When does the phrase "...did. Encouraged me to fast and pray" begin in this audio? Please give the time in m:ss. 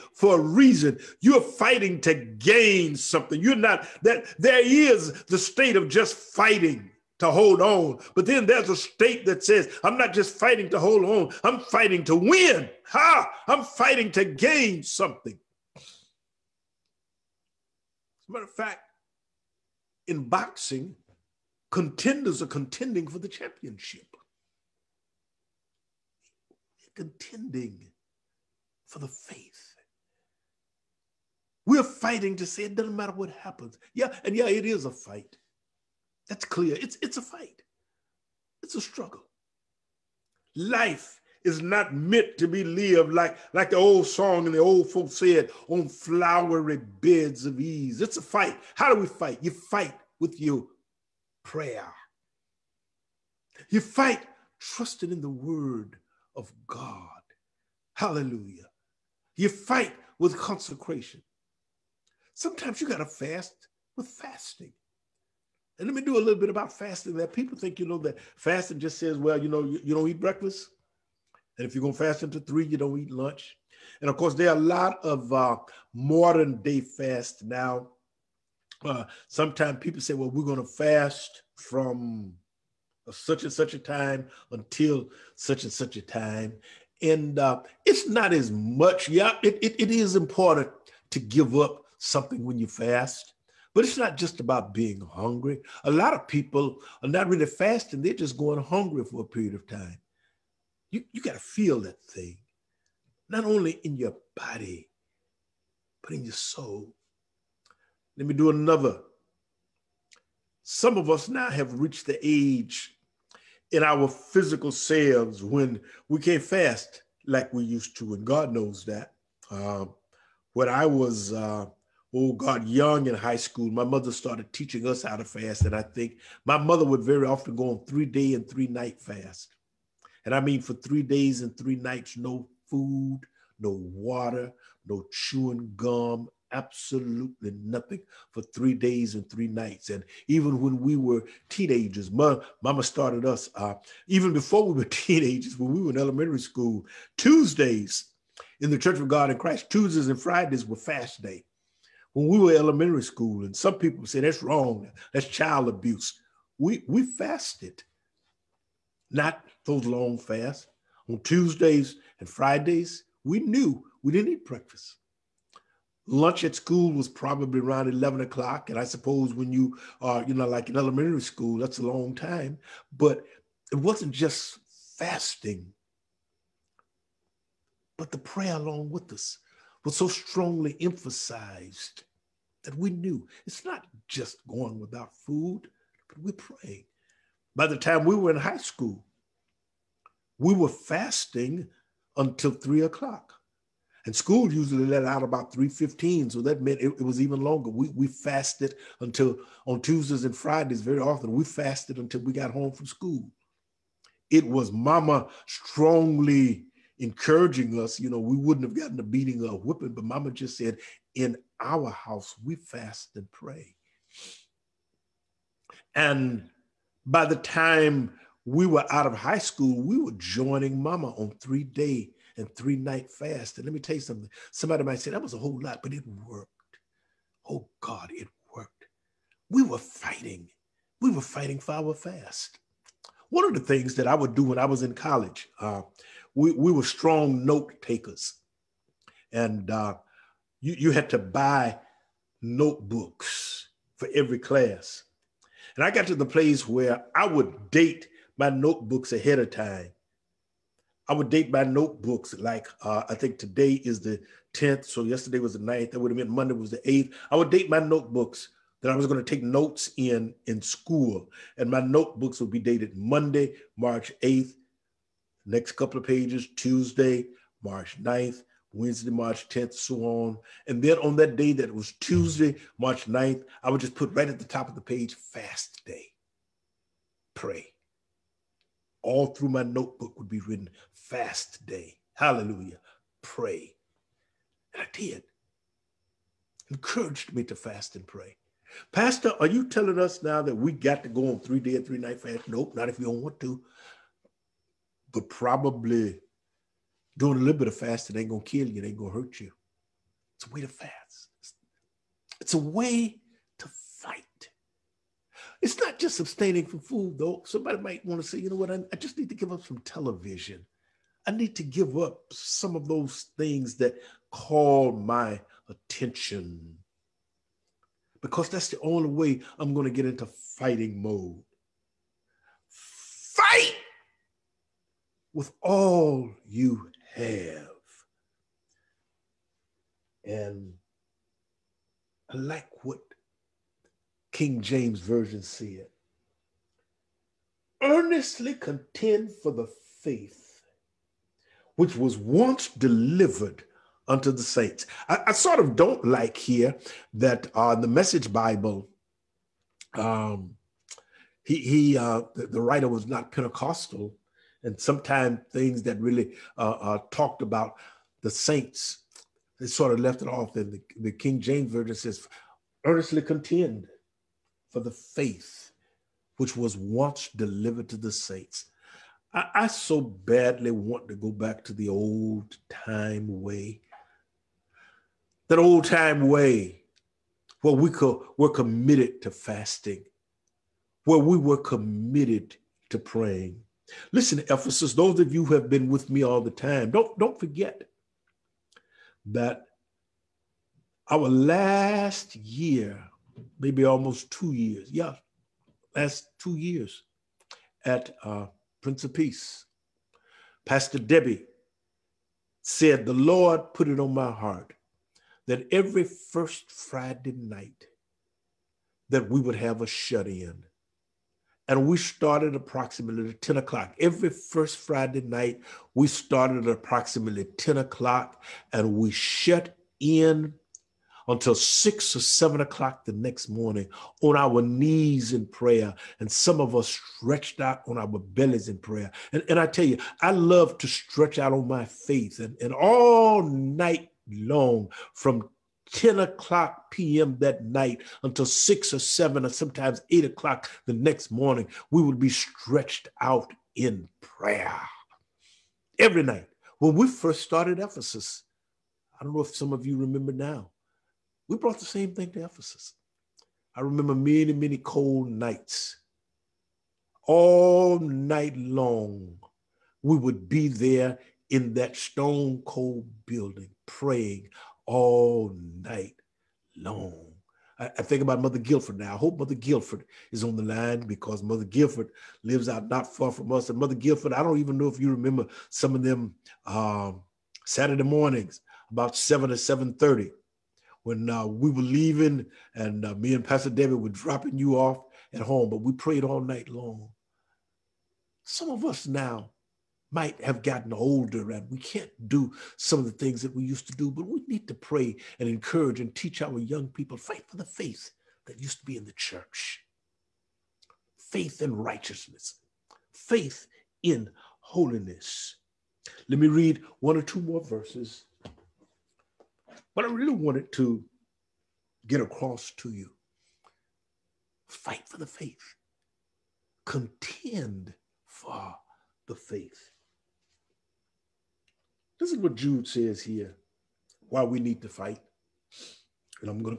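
4:44.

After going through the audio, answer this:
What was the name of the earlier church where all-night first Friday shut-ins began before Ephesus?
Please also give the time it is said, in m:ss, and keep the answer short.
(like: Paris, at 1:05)
Prince of Peace, at 6:38.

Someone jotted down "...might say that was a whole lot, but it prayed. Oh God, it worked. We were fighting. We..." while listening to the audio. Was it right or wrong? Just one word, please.
wrong.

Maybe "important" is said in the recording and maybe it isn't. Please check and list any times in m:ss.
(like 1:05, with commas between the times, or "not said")
1:30.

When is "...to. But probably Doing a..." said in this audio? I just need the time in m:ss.
4:53.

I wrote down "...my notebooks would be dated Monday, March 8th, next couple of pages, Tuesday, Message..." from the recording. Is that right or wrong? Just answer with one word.
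wrong.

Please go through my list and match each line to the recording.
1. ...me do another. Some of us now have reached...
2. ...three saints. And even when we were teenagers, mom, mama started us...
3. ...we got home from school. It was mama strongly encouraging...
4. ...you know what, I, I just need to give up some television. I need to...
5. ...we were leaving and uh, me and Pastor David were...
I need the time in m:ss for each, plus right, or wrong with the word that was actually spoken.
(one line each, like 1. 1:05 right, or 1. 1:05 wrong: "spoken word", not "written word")
1. 1:48 right
2. 2:19 wrong: "nights", not "saints"
3. 3:22 right
4. 5:08 right
5. 8:01 right.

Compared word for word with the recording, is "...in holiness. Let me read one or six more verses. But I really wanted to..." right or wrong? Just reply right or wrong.
wrong.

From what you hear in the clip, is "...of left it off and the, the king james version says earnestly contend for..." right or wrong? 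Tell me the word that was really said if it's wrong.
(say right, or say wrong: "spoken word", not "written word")
right.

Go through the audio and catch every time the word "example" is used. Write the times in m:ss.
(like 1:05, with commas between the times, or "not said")
not said.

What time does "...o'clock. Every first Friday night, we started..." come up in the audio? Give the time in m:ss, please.
6:53.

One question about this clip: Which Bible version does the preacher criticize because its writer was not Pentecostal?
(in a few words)
the Message Bible.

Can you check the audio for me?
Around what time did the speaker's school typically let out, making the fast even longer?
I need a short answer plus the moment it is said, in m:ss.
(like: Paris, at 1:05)
3:15, at 3:15.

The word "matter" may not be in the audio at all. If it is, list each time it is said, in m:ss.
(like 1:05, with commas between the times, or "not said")
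0:18, 0:32.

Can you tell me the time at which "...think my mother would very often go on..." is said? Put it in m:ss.
2:05.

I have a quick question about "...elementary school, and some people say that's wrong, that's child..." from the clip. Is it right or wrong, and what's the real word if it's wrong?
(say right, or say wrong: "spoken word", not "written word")
right.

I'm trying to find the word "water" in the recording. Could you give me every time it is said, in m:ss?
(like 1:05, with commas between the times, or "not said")
2:13.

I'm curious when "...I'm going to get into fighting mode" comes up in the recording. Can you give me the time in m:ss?
5:19.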